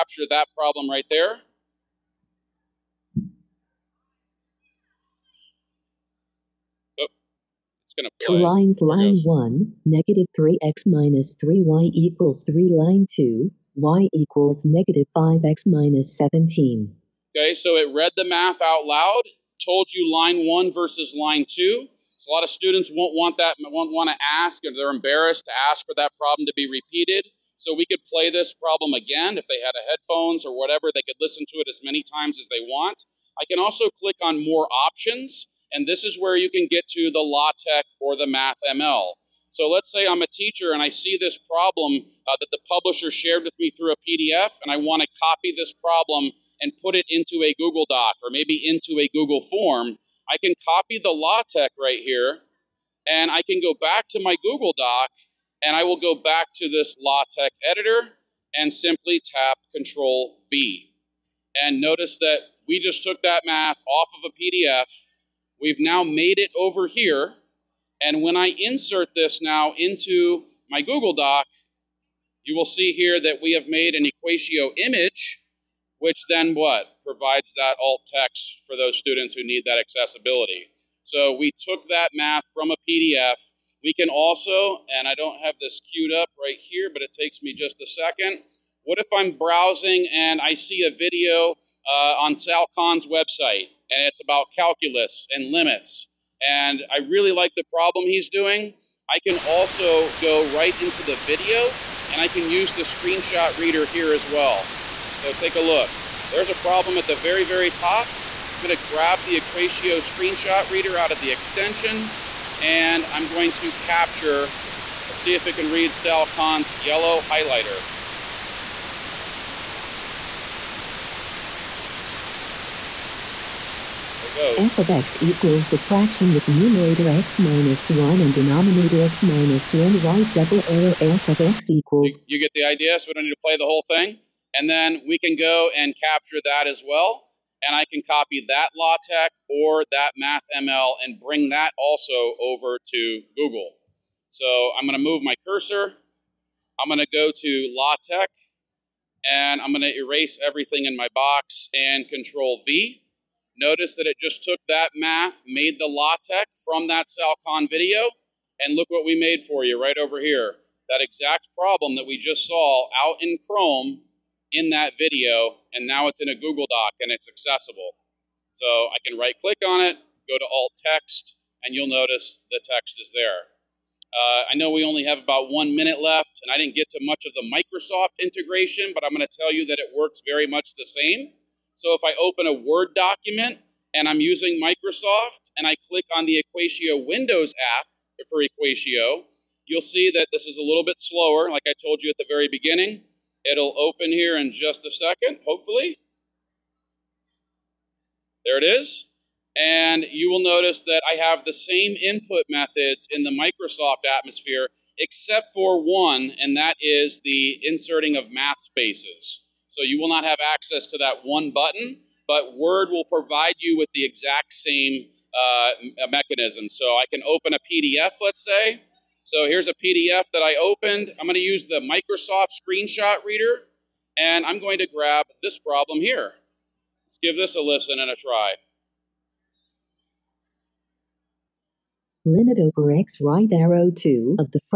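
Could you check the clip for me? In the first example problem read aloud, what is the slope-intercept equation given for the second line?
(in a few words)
y = -5x - 17.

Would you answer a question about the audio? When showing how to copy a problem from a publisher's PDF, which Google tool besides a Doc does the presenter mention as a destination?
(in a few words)
Google form.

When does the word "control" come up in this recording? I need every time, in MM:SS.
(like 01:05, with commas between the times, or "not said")
00:59, 02:32.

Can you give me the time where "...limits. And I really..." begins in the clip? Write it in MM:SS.
01:35.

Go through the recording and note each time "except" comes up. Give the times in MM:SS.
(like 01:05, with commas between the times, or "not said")
03:24.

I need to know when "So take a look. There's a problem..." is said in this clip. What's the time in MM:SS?
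01:45.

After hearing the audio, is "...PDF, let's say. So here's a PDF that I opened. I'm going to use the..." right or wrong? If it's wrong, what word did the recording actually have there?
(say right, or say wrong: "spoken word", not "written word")
right.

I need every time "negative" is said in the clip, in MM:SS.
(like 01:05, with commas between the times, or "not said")
00:09, 00:14.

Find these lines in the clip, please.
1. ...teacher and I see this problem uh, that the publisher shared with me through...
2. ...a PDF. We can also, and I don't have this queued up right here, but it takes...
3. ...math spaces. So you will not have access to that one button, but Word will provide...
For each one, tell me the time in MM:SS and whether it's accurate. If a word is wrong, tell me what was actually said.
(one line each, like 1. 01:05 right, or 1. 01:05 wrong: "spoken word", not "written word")
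1. 00:40 right
2. 01:22 right
3. 03:28 right.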